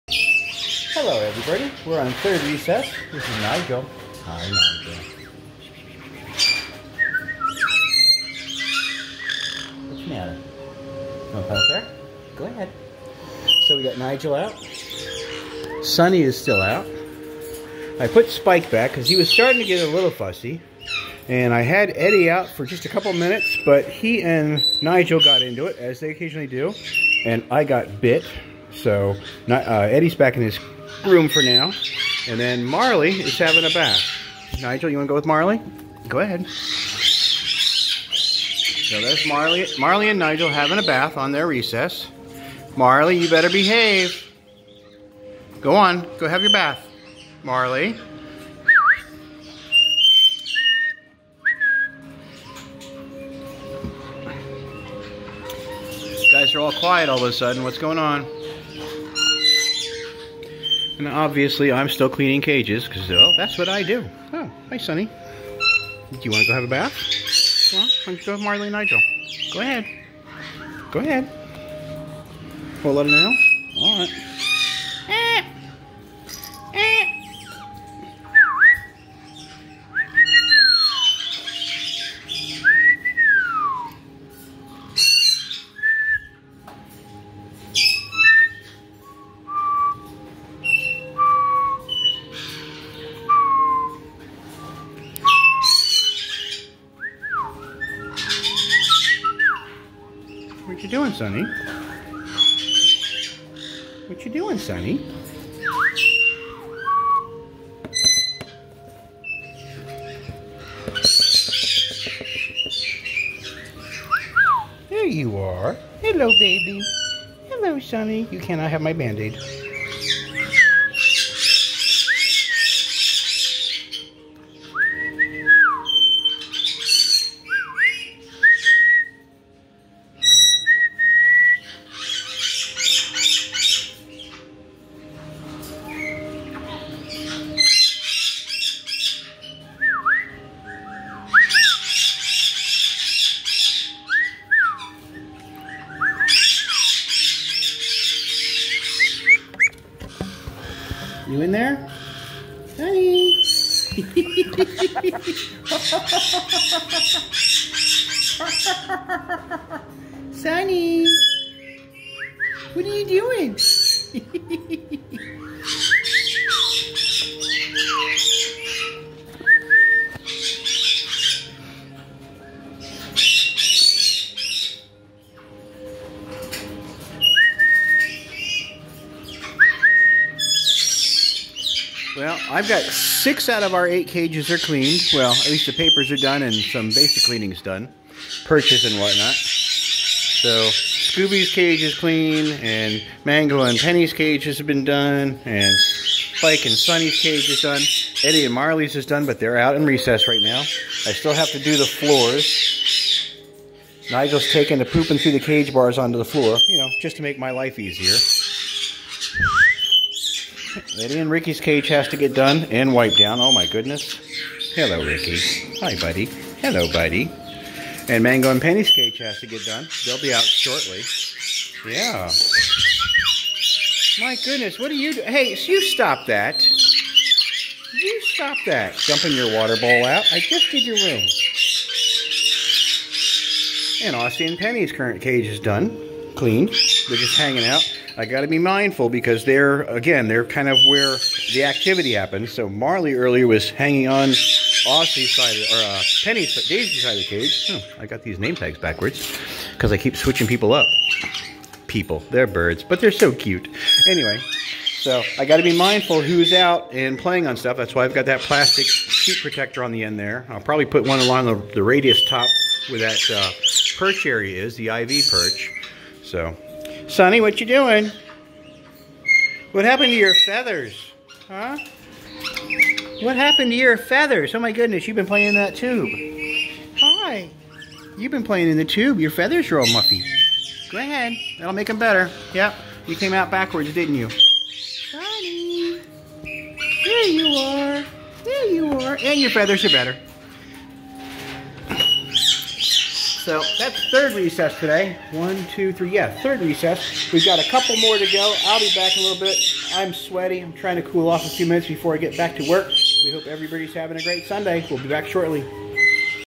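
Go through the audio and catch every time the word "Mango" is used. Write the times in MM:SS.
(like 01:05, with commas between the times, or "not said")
03:13, 03:38.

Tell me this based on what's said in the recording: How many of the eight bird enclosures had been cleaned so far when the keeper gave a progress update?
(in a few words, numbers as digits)
6.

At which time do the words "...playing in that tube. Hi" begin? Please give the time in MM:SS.
04:35.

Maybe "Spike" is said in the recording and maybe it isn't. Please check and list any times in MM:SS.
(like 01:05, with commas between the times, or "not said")
00:18, 03:15.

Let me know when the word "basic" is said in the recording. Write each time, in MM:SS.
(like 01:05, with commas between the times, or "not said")
03:06.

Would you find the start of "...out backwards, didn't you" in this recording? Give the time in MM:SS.
04:43.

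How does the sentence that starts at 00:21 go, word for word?
And I had Eddie out for just a couple minutes, but he and Nigel got into it, as they occasionally do.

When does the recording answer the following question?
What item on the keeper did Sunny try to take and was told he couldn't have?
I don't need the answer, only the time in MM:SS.
01:58.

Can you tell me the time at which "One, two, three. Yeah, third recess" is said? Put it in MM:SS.
04:55.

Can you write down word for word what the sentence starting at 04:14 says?
Anyway, so I got to be mindful who's out and playing on stuff.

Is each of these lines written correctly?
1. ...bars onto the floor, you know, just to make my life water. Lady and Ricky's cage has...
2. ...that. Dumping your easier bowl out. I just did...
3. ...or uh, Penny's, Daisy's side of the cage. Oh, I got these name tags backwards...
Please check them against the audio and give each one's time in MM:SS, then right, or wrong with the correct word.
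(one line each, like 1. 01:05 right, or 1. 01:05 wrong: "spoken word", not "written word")
1. 03:25 wrong: "easier", not "water"
2. 03:48 wrong: "water", not "easier"
3. 04:05 right.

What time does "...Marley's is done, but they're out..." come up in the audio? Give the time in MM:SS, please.
03:18.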